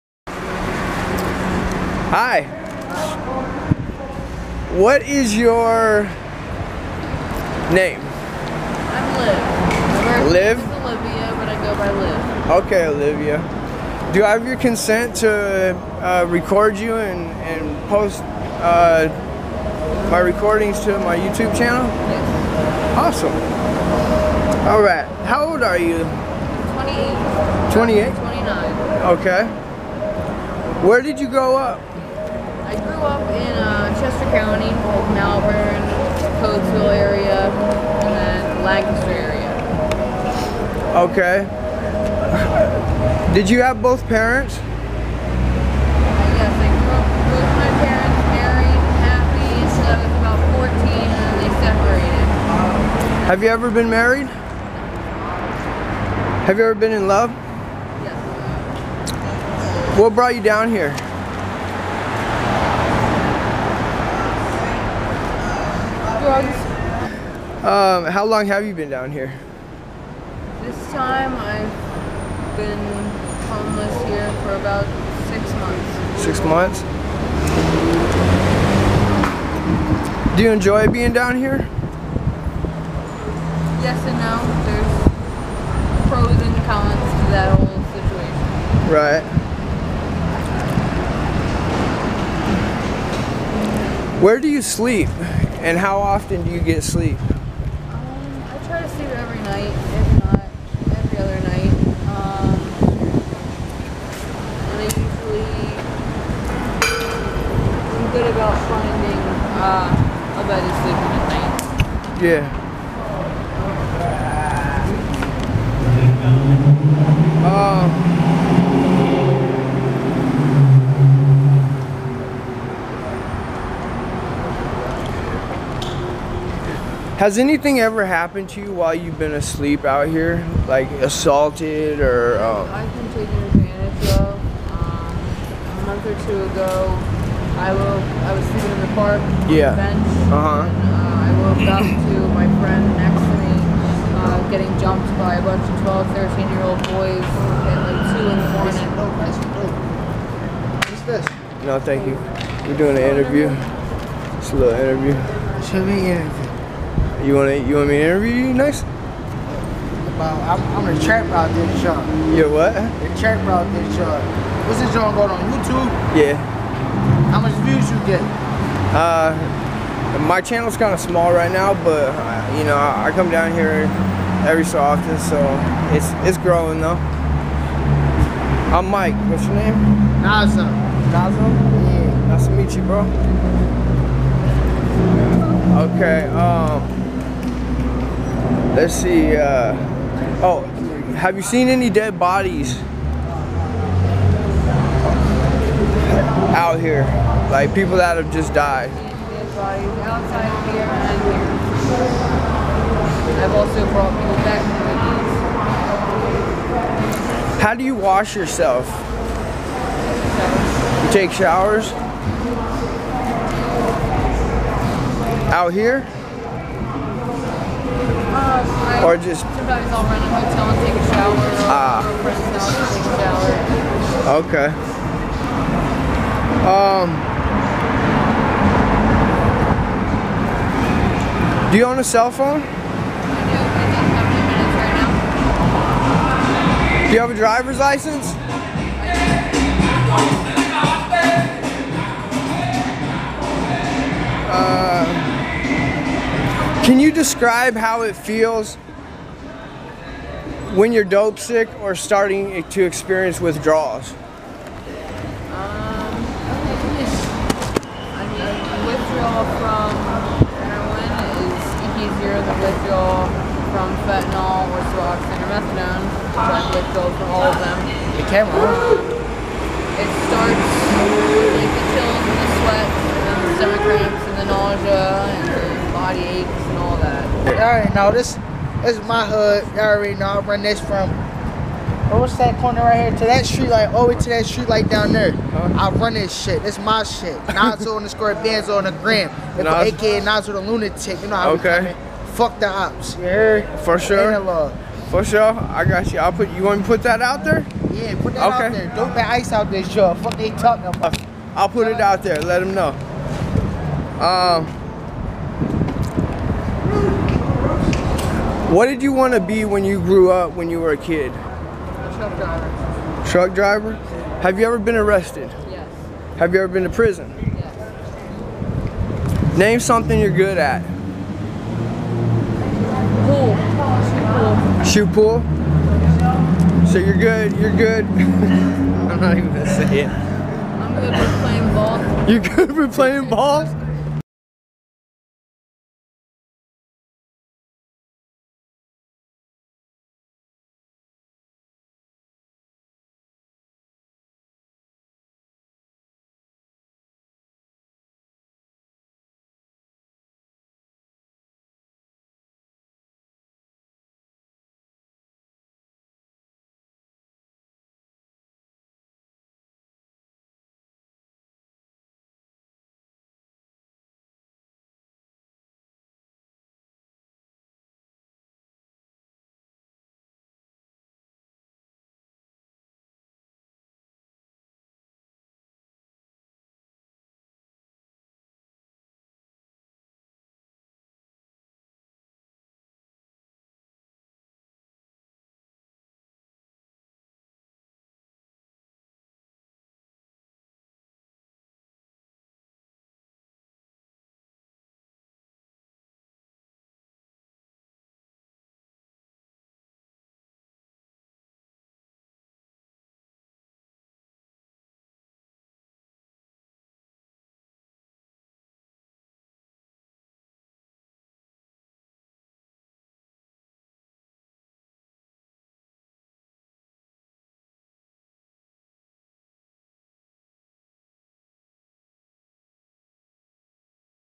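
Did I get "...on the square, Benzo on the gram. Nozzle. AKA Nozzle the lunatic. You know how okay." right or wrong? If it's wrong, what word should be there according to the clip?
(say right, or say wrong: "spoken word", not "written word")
right.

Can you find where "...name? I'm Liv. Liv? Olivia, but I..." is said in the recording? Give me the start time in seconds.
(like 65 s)
7 s.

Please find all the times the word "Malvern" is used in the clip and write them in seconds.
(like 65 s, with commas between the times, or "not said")
35 s.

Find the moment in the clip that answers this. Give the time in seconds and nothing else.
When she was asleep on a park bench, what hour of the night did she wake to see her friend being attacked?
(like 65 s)
148 s.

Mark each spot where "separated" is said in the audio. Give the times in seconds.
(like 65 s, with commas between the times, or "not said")
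51 s.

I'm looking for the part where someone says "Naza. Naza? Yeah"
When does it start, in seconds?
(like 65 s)
180 s.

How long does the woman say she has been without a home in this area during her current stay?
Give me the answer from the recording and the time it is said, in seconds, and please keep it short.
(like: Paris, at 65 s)
About six months, at 74 s.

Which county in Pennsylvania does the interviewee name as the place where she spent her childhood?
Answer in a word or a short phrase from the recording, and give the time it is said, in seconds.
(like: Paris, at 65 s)
Chester County, at 33 s.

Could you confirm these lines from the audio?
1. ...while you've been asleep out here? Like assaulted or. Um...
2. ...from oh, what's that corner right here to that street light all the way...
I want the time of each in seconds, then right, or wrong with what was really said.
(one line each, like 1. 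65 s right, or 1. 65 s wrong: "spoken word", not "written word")
1. 128 s right
2. 280 s right.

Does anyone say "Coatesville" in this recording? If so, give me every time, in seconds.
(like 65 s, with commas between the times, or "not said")
36 s.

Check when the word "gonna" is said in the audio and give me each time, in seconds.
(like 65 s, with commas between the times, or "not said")
329 s.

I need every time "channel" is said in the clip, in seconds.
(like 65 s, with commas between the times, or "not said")
21 s, 170 s.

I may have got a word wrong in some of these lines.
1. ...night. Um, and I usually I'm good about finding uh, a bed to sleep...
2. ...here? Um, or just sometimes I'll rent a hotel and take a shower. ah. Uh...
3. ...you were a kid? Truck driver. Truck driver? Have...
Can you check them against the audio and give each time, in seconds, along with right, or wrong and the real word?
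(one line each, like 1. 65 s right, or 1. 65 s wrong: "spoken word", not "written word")
1. 101 s right
2. 215 s right
3. 310 s right.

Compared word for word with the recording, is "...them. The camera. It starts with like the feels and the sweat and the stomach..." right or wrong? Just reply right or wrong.
wrong.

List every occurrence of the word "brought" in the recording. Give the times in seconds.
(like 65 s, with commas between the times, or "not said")
60 s, 203 s.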